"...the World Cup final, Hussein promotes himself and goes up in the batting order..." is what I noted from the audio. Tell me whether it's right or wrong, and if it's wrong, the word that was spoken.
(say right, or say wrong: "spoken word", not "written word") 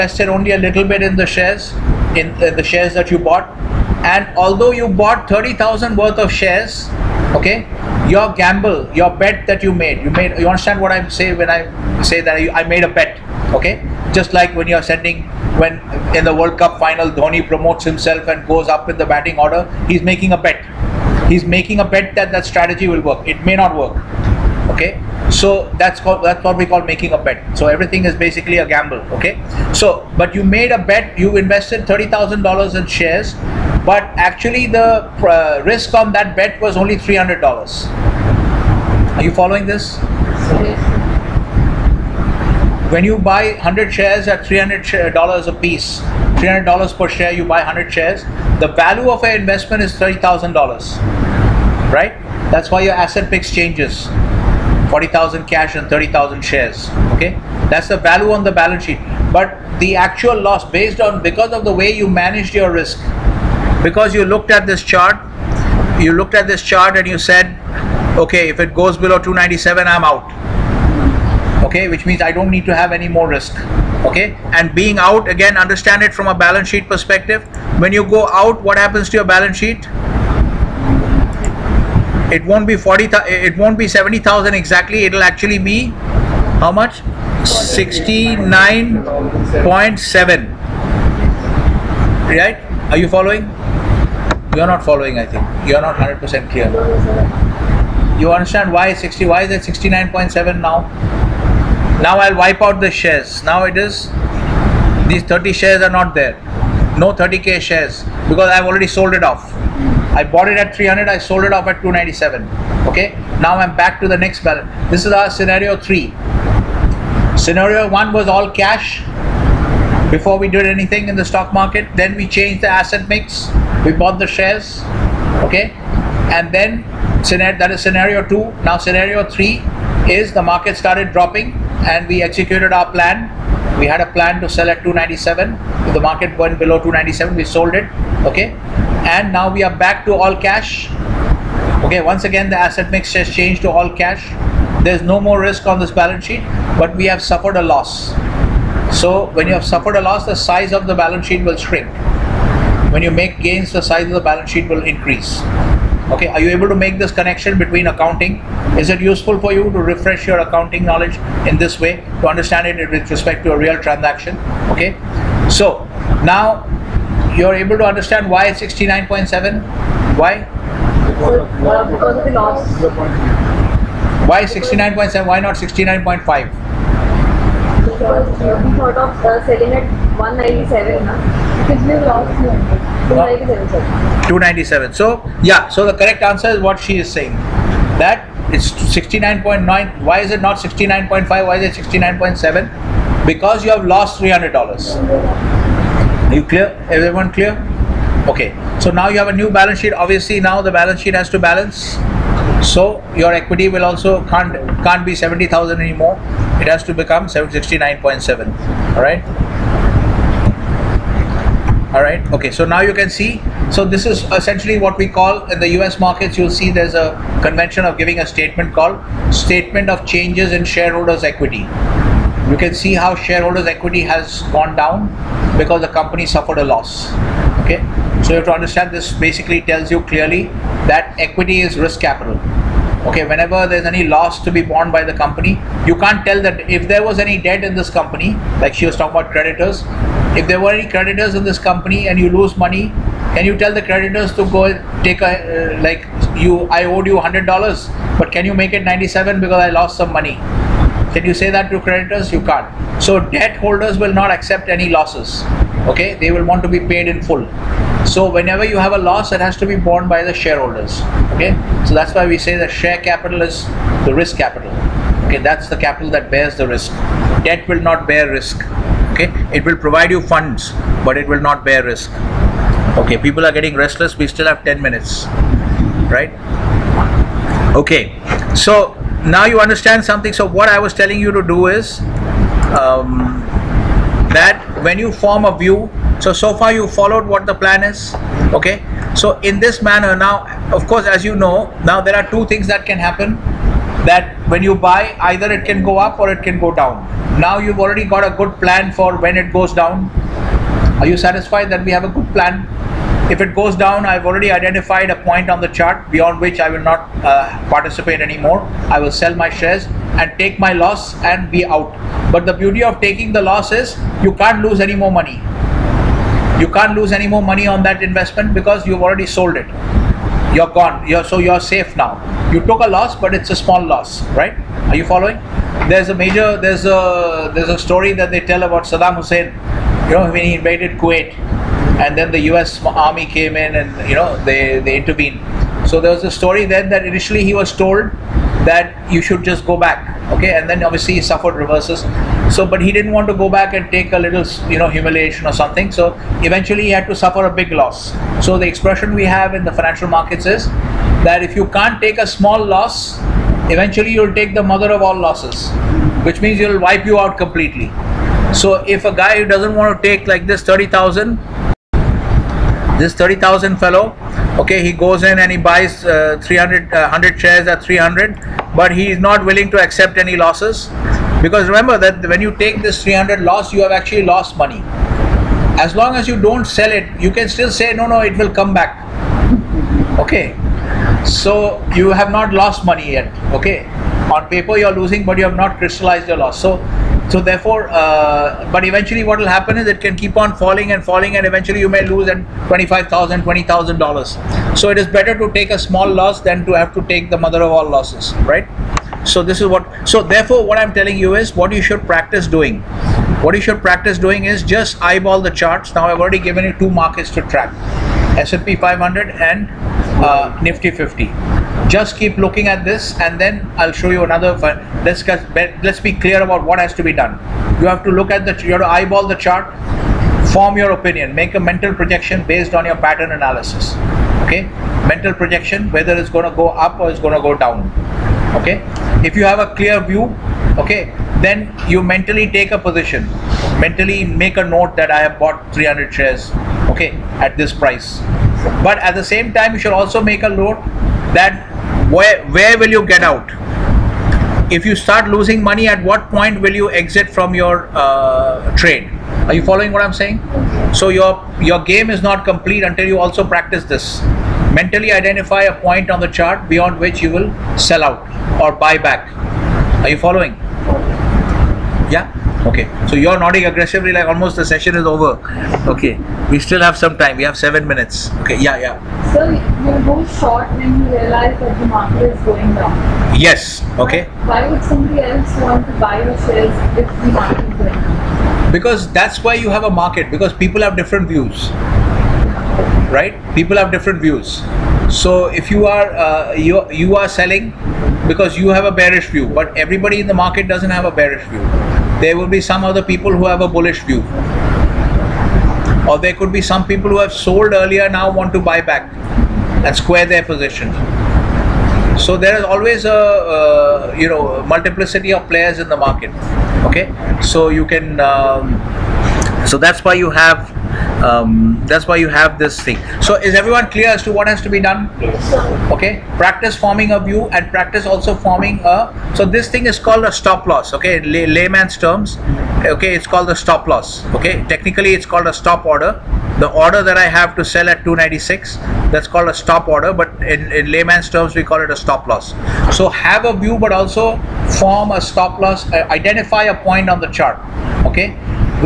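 wrong: "Dhoni", not "Hussein".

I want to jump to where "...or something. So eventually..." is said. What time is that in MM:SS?
05:45.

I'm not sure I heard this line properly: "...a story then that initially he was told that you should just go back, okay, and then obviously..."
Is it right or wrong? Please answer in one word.
right.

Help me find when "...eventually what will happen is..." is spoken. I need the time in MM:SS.
06:28.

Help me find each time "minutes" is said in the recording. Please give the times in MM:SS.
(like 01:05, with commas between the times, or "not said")
04:34, 07:47.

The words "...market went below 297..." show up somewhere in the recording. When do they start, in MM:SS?
02:15.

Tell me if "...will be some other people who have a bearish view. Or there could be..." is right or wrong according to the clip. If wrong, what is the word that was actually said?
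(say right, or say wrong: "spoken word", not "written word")
wrong: "bullish", not "bearish".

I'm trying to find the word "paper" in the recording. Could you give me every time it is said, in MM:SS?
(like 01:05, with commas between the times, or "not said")
06:24.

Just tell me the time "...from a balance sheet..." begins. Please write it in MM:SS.
01:16.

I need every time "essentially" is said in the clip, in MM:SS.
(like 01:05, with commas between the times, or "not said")
03:34.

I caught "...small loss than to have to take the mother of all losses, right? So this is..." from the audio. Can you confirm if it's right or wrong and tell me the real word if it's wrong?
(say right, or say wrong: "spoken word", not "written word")
right.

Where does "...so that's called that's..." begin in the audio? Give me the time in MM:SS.
00:25.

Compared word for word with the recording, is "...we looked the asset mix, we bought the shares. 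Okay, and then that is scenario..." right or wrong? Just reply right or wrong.
wrong.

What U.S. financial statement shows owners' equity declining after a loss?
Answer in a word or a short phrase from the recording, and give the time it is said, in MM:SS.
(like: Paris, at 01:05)
statement of changes in shareholders' equity, at 03:39.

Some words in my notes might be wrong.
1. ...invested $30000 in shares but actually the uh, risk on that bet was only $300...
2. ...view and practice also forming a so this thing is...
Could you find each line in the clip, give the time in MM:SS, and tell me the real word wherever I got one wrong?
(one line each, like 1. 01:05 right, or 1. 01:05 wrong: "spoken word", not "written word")
1. 00:31 right
2. 08:37 right.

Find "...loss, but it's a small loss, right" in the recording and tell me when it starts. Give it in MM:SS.
05:22.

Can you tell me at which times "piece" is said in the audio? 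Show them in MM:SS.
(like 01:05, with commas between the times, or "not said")
00:45.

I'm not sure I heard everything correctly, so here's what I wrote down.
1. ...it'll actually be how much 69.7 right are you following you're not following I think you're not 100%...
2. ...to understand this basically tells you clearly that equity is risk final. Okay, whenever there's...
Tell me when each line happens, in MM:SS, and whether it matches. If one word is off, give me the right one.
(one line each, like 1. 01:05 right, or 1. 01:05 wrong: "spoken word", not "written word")
1. 01:25 right
2. 03:48 wrong: "capital", not "final".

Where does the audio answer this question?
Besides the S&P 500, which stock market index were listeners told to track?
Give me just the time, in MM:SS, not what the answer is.
06:50.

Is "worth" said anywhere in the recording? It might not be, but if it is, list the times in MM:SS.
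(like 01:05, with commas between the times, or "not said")
00:05.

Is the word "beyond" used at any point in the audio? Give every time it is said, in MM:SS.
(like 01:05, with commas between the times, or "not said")
05:06, 07:36.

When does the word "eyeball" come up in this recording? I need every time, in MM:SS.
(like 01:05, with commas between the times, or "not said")
06:45, 06:58.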